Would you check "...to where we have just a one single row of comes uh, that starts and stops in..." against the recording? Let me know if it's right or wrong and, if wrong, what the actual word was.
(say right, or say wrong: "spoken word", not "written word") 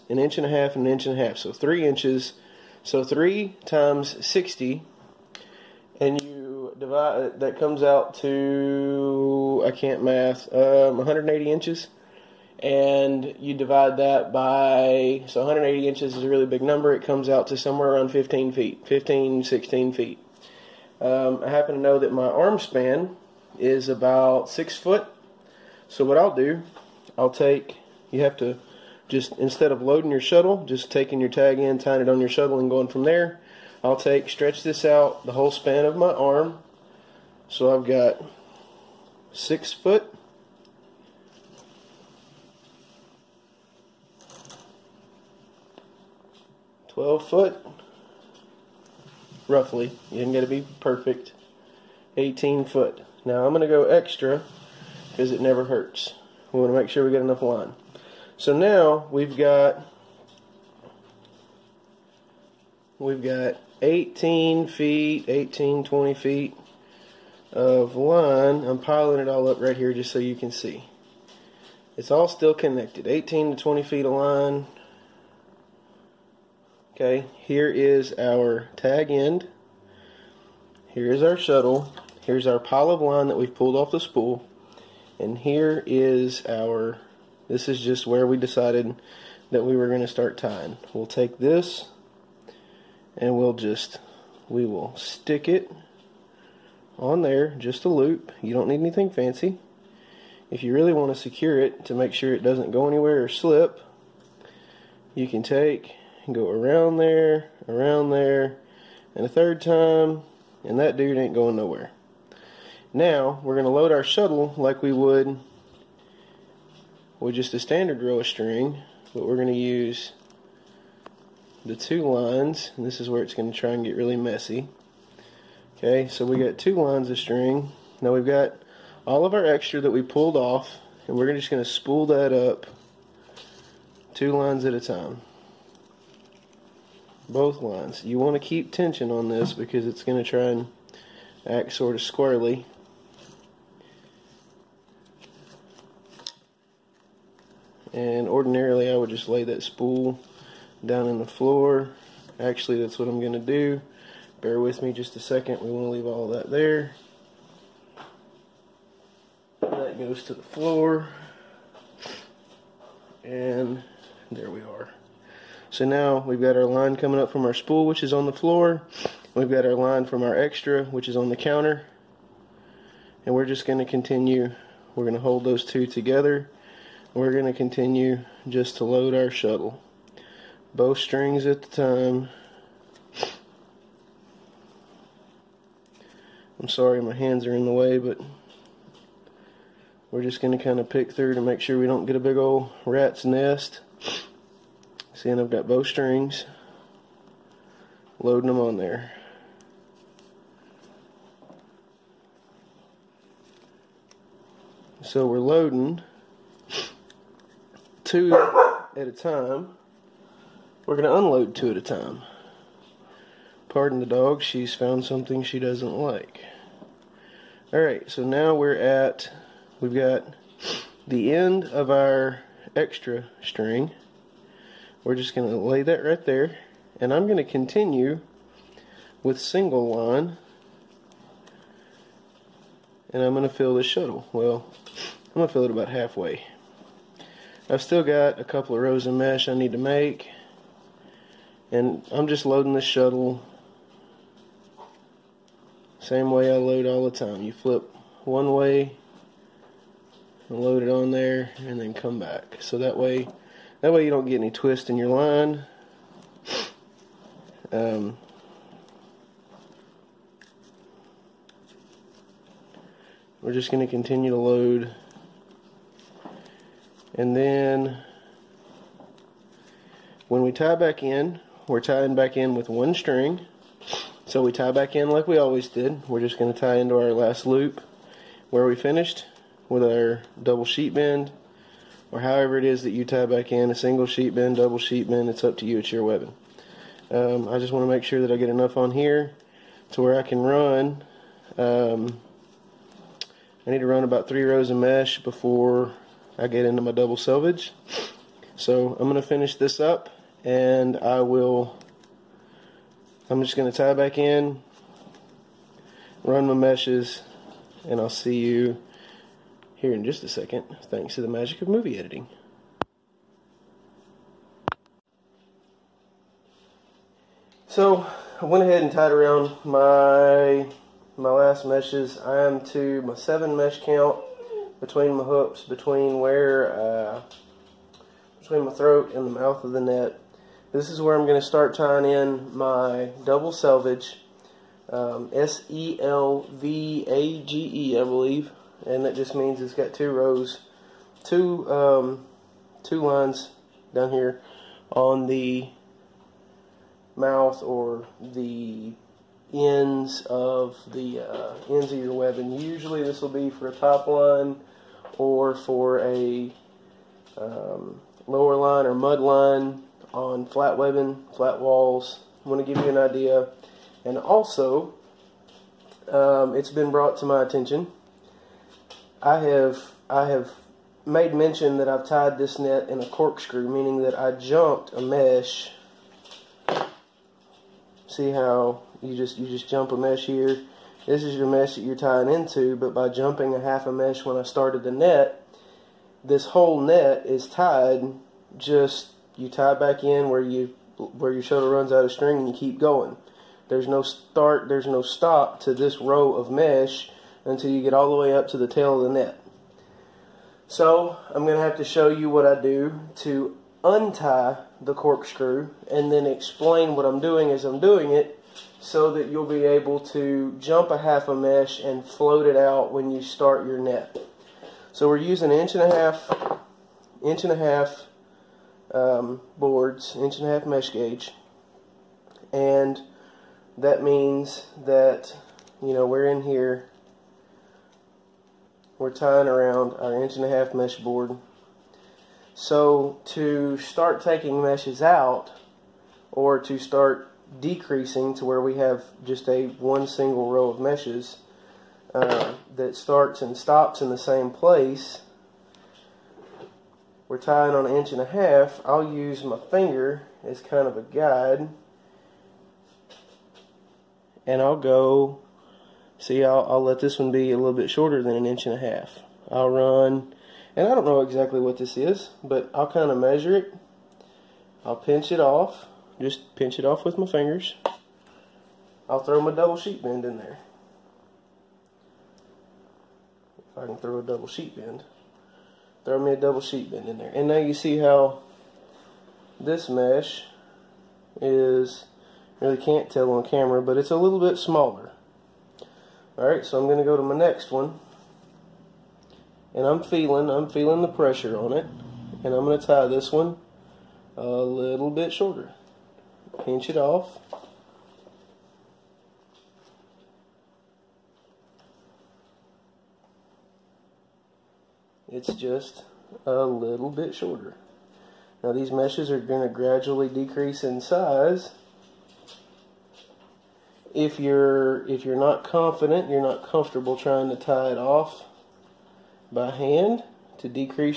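wrong: "meshes", not "comes".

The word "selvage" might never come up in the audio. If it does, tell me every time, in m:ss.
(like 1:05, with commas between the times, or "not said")
4:57, 5:33.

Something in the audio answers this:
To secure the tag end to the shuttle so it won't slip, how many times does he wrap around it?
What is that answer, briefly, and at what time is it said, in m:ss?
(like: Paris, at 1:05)
3, at 1:49.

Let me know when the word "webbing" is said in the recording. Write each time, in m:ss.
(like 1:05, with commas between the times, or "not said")
4:46, 6:00.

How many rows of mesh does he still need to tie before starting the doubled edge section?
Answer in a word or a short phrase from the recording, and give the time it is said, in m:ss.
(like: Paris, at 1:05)
3, at 4:54.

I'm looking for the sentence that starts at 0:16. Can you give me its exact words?
It comes out to somewhere around 15 feet, 15 16 feet.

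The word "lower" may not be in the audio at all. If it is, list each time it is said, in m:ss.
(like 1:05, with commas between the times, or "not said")
5:58.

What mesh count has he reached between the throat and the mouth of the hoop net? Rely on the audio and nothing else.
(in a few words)
7.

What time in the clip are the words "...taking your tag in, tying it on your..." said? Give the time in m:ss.
0:30.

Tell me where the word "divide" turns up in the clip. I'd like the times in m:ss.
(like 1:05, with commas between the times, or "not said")
0:06, 0:13.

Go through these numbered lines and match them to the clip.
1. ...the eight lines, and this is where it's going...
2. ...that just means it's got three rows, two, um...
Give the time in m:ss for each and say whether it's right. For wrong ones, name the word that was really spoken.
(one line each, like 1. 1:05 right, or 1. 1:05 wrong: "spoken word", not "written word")
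1. 2:01 wrong: "two", not "eight"
2. 5:39 wrong: "two", not "three".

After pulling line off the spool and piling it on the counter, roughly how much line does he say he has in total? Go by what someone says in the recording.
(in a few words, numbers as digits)
18 to 20 feet.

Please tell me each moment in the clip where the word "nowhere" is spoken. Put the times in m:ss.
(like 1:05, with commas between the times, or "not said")
1:51.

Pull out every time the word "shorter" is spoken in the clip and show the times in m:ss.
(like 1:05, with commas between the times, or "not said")
7:37, 8:15, 8:27.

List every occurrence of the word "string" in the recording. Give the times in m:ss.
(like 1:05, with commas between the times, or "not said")
1:58, 2:07, 3:00, 3:15, 3:43, 4:32, 6:32.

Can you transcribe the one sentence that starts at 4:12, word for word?
So that way that way you don't get any twist in your line.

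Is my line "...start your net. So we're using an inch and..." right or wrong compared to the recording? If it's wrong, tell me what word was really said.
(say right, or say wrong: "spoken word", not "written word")
right.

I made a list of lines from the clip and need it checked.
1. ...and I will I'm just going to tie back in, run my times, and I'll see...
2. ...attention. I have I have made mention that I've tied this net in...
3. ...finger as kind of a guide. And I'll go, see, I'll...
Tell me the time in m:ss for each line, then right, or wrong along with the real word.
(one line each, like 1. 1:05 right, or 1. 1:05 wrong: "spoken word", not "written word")
1. 5:00 wrong: "meshes", not "times"
2. 6:07 right
3. 7:29 right.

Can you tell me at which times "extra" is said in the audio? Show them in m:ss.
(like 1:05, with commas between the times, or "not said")
0:53, 2:09, 2:50, 3:42.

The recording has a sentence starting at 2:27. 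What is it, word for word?
And ordinarily I would just lay that spool down in the floor.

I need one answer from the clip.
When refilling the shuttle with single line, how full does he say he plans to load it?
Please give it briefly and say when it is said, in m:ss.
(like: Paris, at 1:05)
About halfway, at 3:55.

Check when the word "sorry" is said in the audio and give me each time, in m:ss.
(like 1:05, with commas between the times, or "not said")
3:06.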